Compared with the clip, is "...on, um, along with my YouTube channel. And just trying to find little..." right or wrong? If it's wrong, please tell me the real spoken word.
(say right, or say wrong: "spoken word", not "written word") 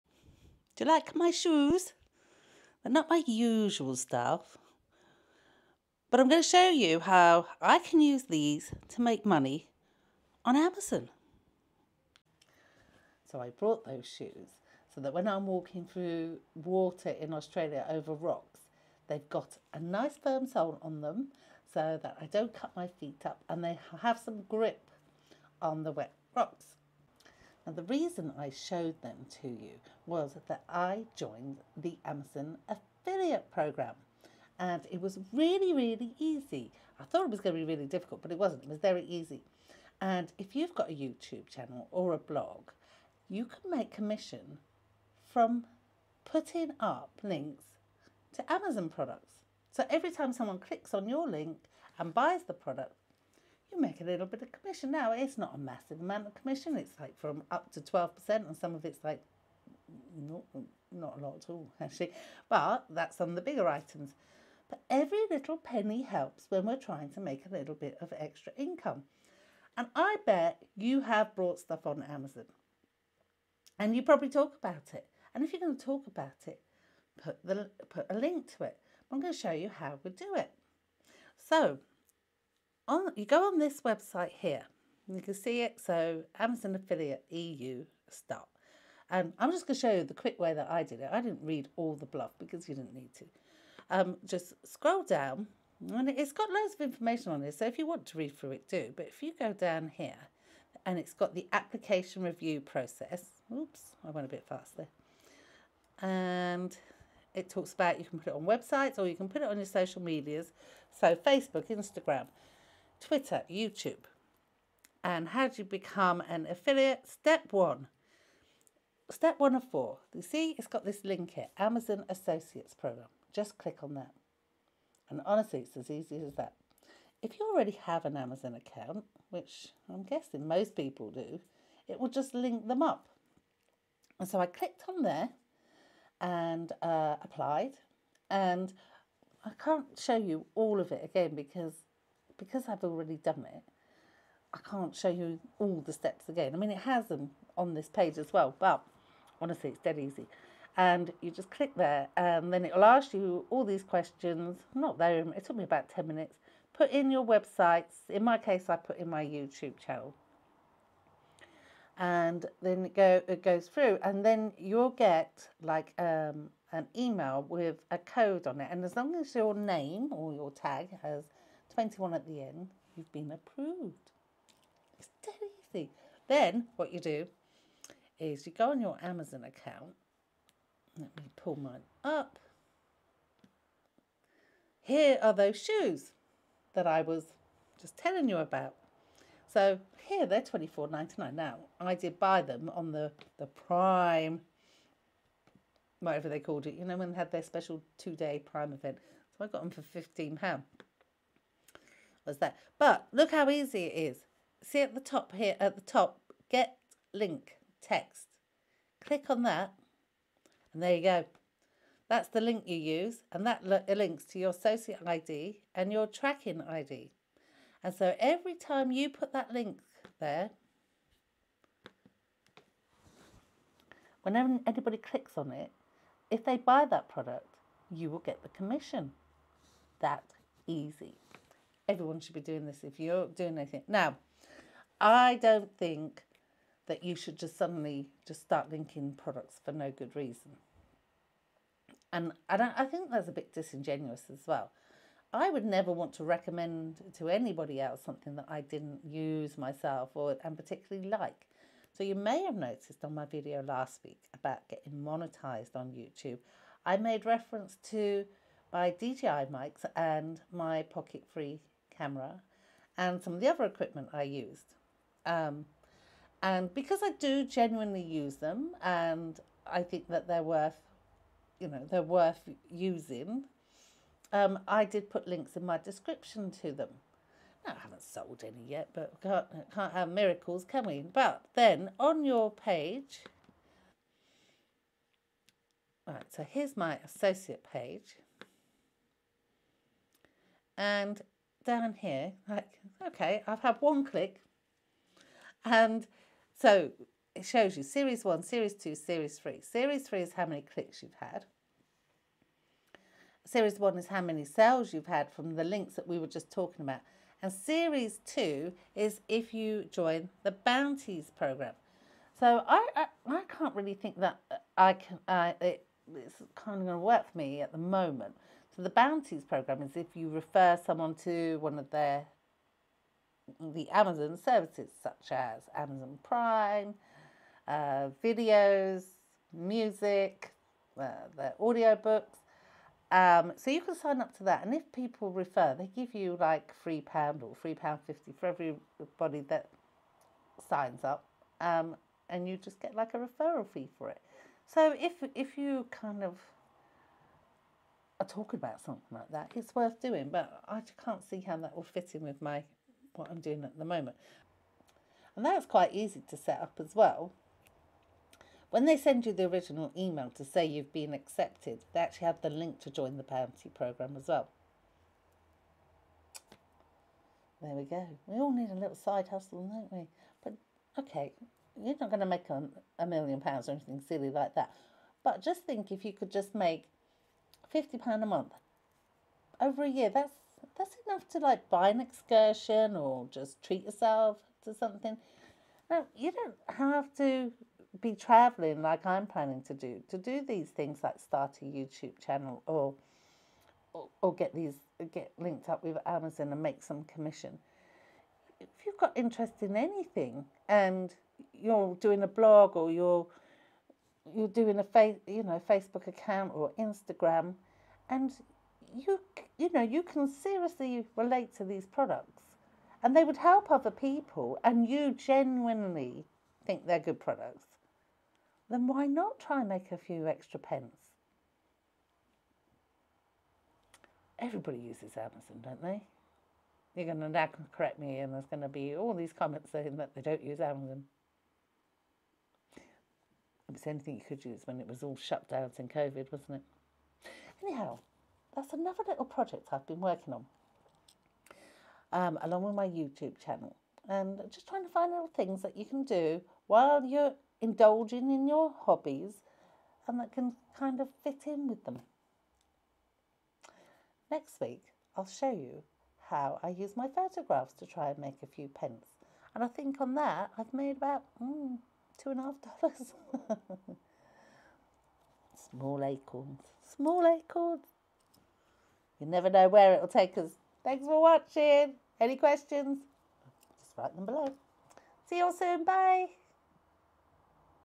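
right.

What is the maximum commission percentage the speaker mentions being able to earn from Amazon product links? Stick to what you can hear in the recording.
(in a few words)
12%.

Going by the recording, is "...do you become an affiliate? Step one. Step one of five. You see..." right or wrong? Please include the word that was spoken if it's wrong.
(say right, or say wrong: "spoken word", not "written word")
wrong: "four", not "five".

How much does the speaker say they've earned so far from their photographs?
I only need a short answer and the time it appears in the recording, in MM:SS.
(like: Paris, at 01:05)
$2.50, at 07:42.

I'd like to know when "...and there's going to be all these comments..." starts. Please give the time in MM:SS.
07:08.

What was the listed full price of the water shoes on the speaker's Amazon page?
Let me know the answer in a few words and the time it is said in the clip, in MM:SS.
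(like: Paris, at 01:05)
£24.99, at 03:10.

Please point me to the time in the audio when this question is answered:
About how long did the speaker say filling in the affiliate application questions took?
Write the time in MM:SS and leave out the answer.
02:35.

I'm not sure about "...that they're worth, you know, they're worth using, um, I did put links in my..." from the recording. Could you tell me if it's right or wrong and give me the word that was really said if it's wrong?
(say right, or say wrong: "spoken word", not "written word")
right.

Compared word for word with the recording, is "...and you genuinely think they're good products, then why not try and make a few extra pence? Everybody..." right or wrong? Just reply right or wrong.
right.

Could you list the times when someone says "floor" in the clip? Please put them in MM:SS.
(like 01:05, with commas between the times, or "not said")
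not said.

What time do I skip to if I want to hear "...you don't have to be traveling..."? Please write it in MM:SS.
06:26.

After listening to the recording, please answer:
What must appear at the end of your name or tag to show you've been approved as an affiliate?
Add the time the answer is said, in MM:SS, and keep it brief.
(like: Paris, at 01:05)
21, at 02:51.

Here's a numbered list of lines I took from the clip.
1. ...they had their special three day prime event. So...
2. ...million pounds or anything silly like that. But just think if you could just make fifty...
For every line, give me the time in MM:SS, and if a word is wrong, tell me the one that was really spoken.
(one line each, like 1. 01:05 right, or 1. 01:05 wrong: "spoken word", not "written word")
1. 03:17 wrong: "two", not "three"
2. 06:13 right.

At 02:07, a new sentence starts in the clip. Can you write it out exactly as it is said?
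If you already have an Amazon account, which I'm guessing most people do, it will just link them up.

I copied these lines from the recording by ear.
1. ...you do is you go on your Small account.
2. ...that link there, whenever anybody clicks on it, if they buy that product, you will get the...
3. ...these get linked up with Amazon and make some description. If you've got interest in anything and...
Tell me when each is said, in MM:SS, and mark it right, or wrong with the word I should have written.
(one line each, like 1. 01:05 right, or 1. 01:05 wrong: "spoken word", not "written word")
1. 02:56 wrong: "Amazon", not "Small"
2. 03:39 right
3. 06:34 wrong: "commission", not "description".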